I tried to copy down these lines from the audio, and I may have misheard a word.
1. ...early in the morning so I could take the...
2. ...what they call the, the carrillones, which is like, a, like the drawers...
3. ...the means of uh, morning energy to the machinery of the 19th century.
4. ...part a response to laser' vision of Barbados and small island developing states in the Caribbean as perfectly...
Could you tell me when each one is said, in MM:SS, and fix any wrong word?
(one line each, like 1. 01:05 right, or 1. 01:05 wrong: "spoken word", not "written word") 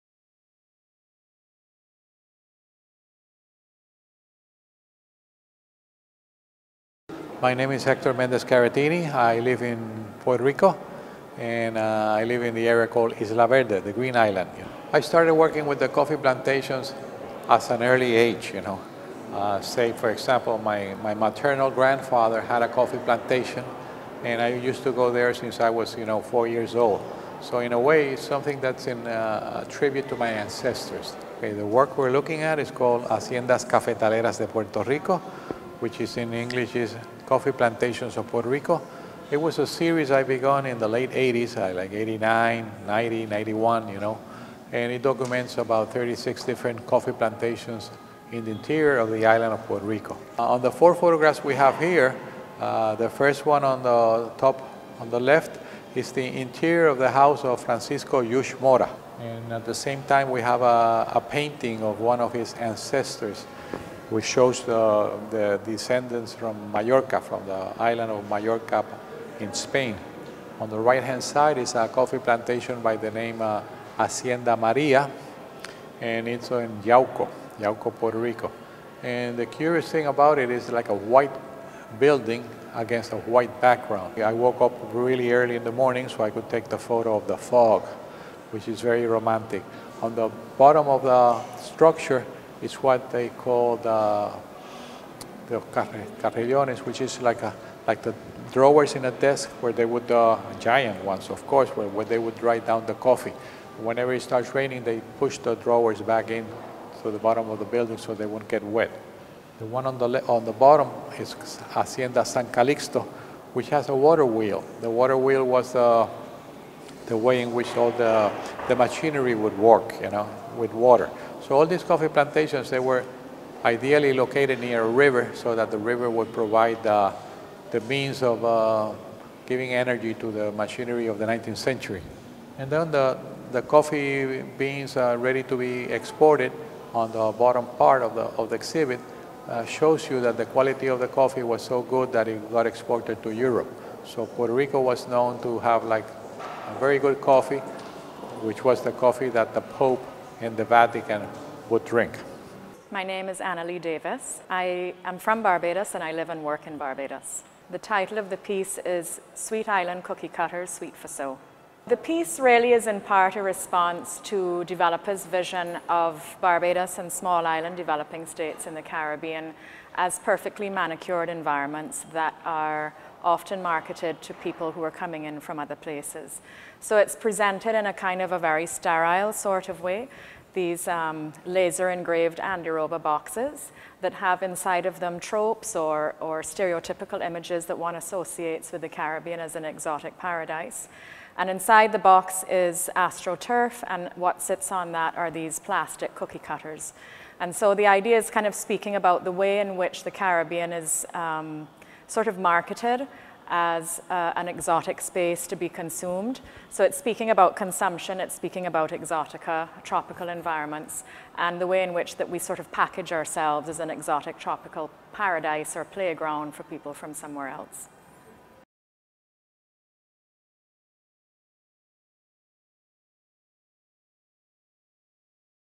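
1. 01:25 right
2. 01:32 right
3. 02:07 wrong: "giving", not "morning"
4. 02:43 wrong: "developers", not "laser".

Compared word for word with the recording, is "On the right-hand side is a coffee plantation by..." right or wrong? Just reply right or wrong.
right.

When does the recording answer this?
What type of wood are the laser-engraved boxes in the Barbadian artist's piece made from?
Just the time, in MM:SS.
03:02.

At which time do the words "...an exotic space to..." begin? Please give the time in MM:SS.
03:24.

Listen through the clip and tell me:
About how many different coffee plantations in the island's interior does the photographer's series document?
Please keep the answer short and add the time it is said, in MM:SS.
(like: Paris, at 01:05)
36, at 00:45.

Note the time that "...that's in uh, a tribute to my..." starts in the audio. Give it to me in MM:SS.
00:28.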